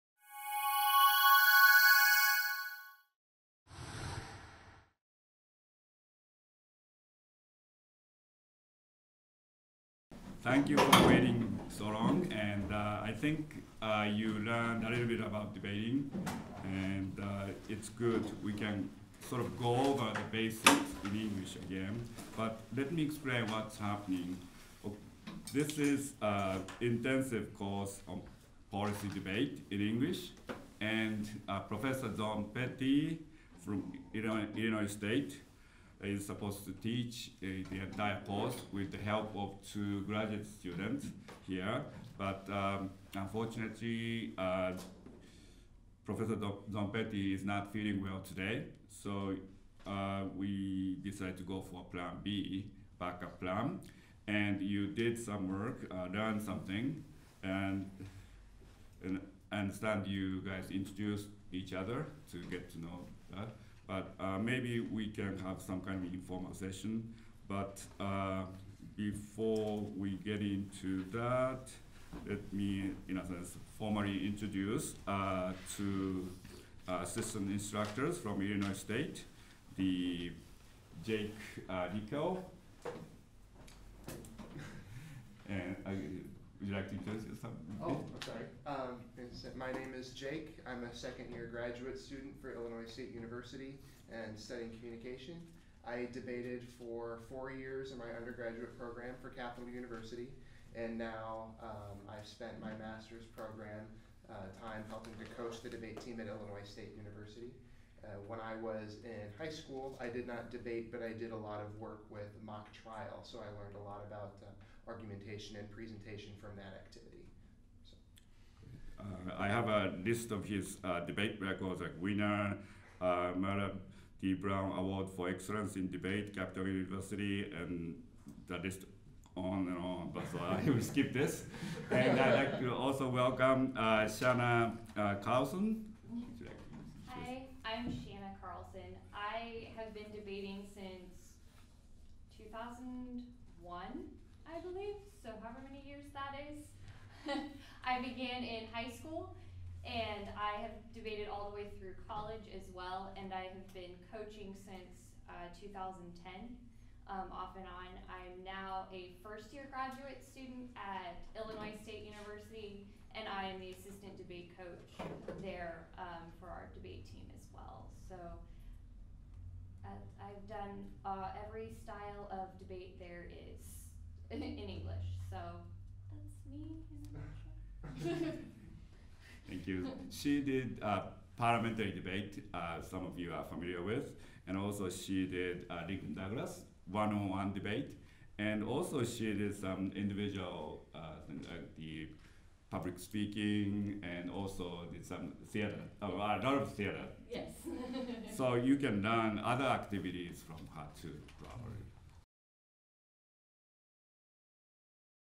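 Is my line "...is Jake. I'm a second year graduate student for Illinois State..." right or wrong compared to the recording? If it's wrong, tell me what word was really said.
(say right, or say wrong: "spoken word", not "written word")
right.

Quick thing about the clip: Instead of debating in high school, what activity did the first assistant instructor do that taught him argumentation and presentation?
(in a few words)
mock trial.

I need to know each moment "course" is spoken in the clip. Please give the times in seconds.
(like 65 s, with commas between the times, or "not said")
27 s, 38 s.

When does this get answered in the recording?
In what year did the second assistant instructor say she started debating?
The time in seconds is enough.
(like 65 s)
142 s.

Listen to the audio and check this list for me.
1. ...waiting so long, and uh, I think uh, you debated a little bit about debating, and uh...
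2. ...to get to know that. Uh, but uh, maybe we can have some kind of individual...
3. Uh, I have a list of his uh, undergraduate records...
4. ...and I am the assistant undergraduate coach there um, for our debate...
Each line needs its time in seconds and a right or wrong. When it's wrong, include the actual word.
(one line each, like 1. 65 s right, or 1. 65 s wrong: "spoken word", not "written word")
1. 11 s wrong: "learned", not "debated"
2. 62 s wrong: "informal", not "individual"
3. 119 s wrong: "debate", not "undergraduate"
4. 163 s wrong: "debate", not "undergraduate".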